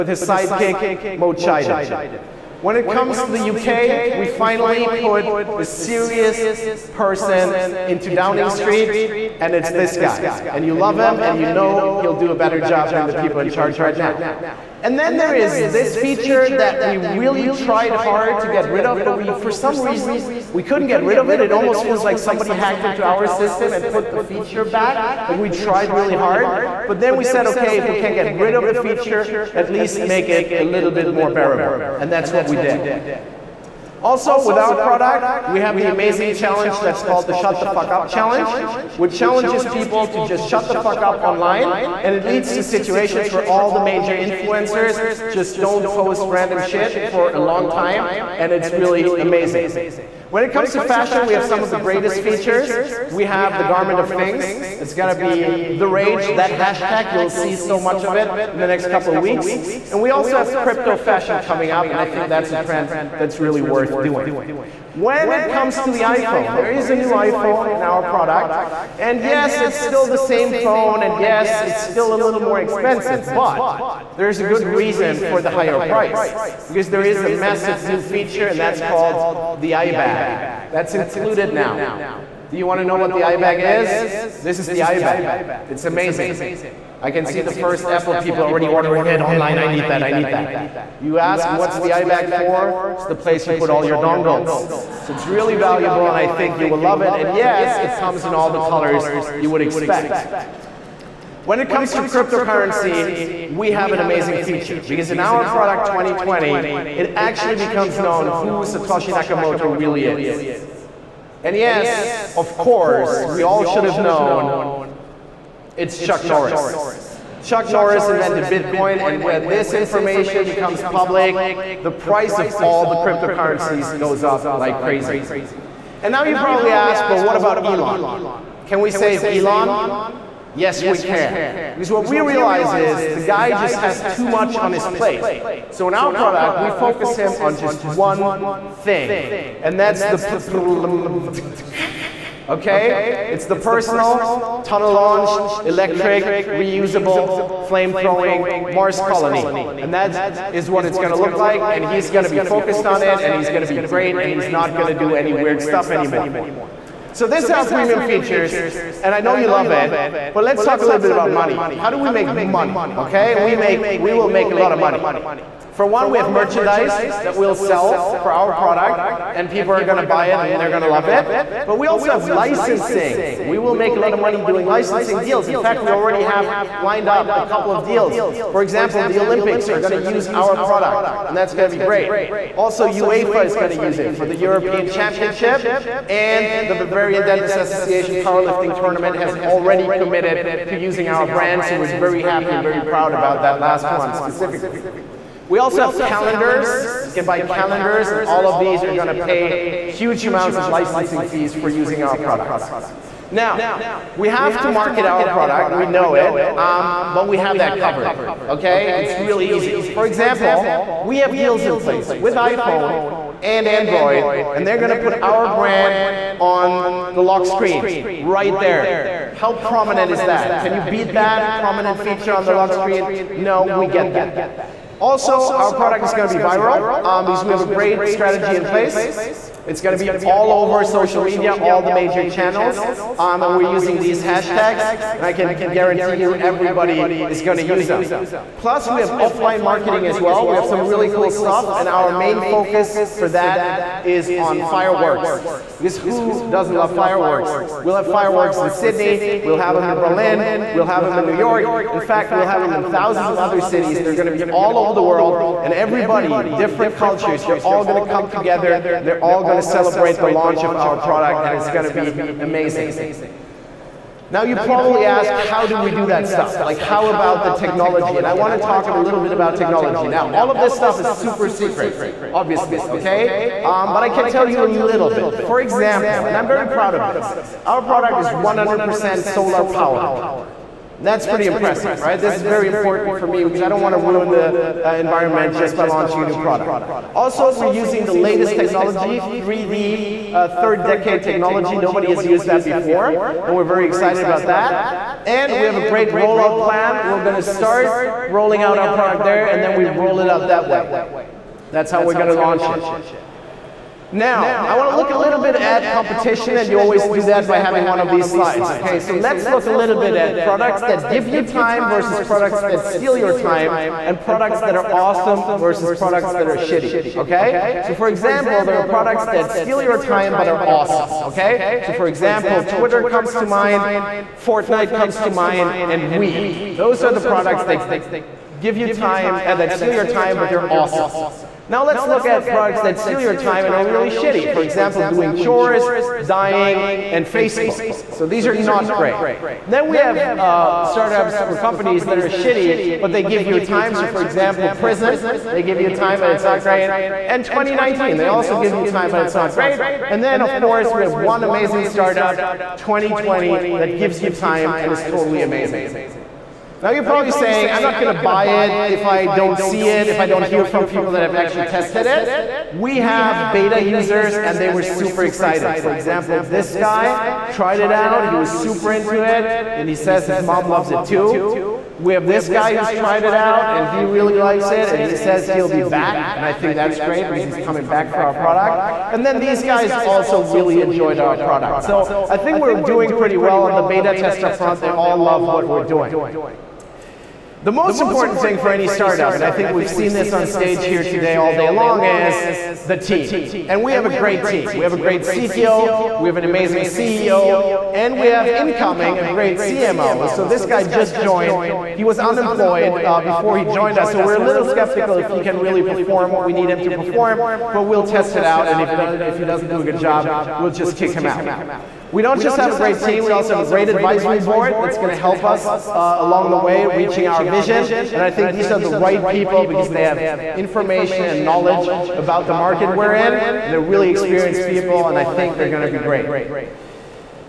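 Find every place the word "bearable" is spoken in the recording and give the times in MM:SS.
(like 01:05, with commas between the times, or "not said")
00:31.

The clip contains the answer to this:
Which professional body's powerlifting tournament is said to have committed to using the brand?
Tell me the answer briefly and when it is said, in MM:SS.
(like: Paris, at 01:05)
Bavarian Dentist Association, at 03:06.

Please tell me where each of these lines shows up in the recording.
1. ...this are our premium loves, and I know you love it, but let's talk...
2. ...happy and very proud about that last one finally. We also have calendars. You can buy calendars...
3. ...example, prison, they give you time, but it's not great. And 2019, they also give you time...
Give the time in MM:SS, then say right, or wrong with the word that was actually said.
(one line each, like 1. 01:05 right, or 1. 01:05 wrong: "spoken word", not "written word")
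1. 02:37 wrong: "features", not "loves"
2. 03:12 wrong: "specifically", not "finally"
3. 05:44 right.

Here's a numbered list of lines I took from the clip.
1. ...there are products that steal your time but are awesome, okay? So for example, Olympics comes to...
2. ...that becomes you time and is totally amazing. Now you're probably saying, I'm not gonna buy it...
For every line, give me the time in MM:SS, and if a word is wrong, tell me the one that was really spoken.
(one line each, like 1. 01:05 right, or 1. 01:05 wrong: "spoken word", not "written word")
1. 05:18 wrong: "Twitter", not "Olympics"
2. 05:53 wrong: "gives", not "becomes".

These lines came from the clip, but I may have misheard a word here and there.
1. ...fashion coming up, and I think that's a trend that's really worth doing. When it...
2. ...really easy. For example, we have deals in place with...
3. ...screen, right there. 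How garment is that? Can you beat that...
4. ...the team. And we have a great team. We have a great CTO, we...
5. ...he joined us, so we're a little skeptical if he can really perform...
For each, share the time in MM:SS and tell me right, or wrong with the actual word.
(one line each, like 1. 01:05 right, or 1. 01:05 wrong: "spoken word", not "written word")
1. 01:00 right
2. 03:29 right
3. 03:37 wrong: "prominent", not "garment"
4. 06:32 right
5. 06:43 right.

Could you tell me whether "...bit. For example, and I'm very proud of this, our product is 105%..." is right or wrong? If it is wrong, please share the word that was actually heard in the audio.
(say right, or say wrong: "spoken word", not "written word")
wrong: "100", not "105".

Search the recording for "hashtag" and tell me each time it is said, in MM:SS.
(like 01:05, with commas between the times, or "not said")
00:56, 03:54.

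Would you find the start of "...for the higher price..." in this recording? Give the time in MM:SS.
01:15.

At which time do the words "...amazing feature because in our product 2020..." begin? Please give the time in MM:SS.
01:43.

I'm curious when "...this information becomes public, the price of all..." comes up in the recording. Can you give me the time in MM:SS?
01:59.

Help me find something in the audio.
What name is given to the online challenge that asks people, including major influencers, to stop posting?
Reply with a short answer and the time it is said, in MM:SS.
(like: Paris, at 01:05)
Shut the Fuck Up Challenge, at 00:37.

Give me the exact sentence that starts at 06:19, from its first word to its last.
And then these guys also really enjoyed our product.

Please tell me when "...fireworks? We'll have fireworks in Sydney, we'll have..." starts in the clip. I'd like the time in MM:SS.
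04:06.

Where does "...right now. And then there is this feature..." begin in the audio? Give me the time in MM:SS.
00:13.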